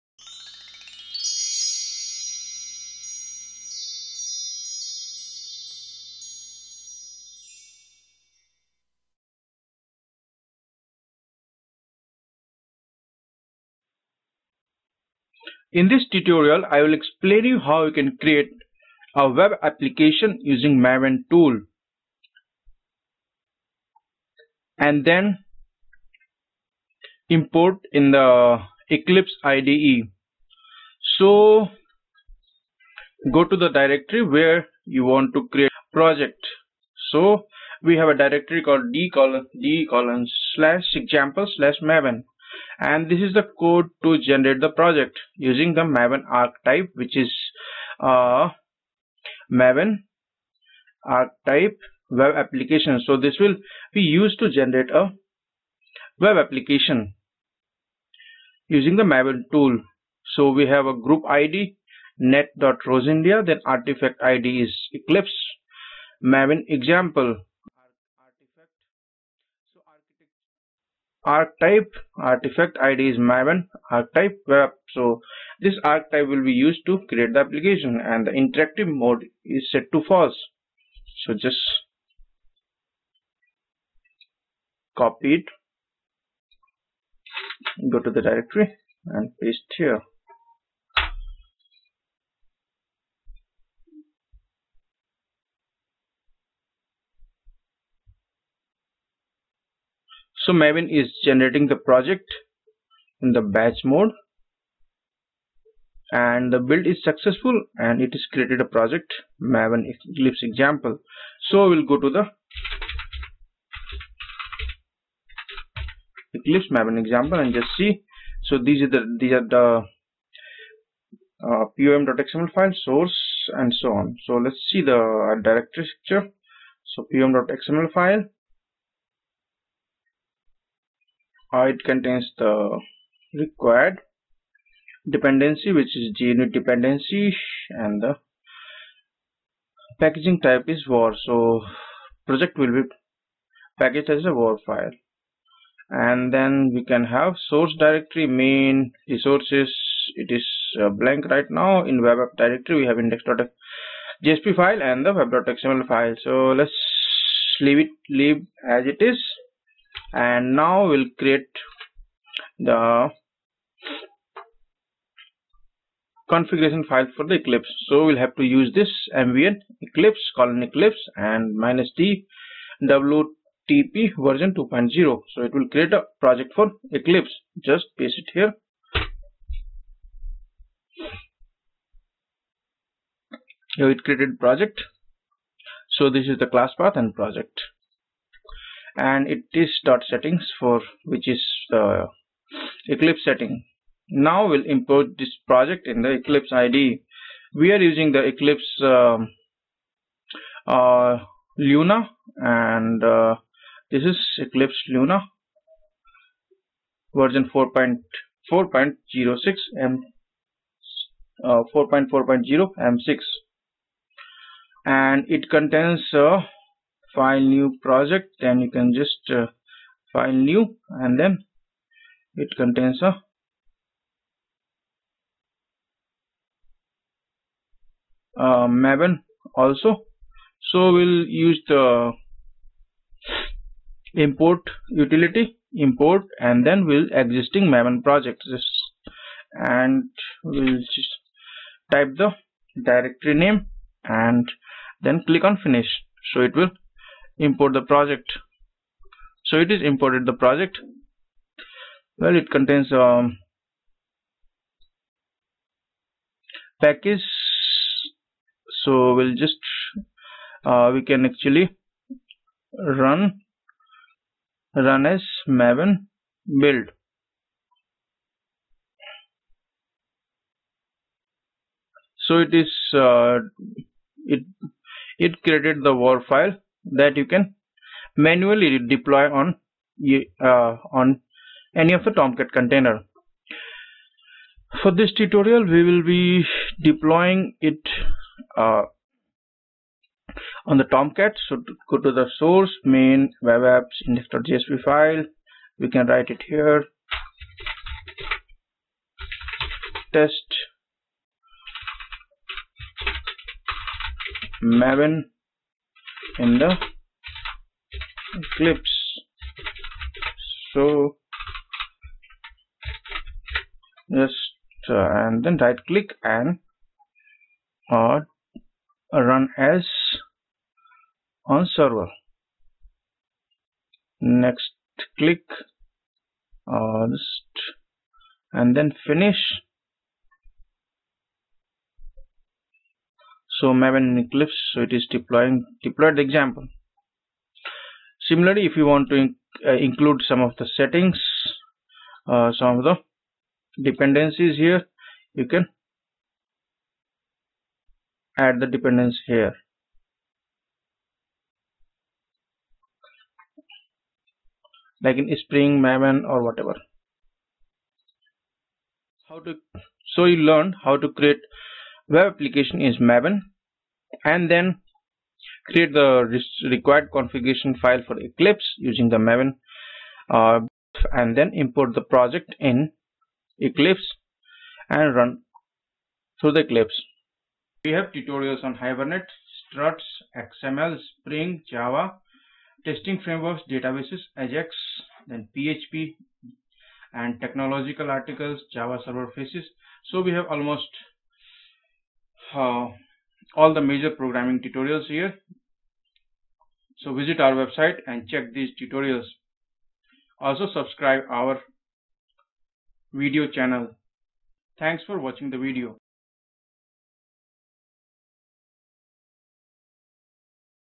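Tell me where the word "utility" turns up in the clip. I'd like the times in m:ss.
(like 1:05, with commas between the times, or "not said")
3:54.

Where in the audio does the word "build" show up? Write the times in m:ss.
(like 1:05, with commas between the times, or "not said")
1:46, 4:26.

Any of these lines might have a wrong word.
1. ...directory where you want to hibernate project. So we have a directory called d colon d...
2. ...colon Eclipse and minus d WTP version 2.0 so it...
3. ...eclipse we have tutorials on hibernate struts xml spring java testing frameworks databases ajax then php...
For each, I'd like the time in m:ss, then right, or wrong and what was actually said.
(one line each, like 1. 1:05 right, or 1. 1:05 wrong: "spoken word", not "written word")
1. 0:33 wrong: "create", not "hibernate"
2. 2:50 right
3. 6:16 right.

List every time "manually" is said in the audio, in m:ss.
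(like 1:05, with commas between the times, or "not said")
4:38.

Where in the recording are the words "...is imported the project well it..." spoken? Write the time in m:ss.
4:09.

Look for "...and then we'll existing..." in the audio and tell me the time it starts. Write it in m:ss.
3:56.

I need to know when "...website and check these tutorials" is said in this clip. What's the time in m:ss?
6:37.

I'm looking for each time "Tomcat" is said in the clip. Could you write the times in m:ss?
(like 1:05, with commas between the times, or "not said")
4:42, 4:50.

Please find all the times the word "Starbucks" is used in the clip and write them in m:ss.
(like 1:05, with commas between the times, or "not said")
not said.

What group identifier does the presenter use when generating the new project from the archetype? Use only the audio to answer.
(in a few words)
net.roseindia.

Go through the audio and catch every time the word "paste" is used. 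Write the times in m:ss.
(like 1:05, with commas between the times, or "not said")
1:29, 2:57.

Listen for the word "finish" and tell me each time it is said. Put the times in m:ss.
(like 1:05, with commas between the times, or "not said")
4:05, 5:29.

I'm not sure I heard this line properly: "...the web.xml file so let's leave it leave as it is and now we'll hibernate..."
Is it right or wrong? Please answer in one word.
wrong.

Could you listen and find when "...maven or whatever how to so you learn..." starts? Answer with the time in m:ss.
5:55.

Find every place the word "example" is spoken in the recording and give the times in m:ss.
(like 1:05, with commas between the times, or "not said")
0:40, 1:06, 1:50, 1:56, 5:36.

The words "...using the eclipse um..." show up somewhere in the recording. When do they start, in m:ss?
3:17.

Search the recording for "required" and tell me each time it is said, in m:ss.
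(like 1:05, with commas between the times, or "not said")
2:13, 6:06.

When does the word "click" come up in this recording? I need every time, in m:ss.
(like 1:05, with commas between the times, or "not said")
4:05, 5:15, 5:25.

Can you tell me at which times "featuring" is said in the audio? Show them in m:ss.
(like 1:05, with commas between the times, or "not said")
not said.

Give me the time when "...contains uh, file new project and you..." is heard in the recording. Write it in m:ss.
3:35.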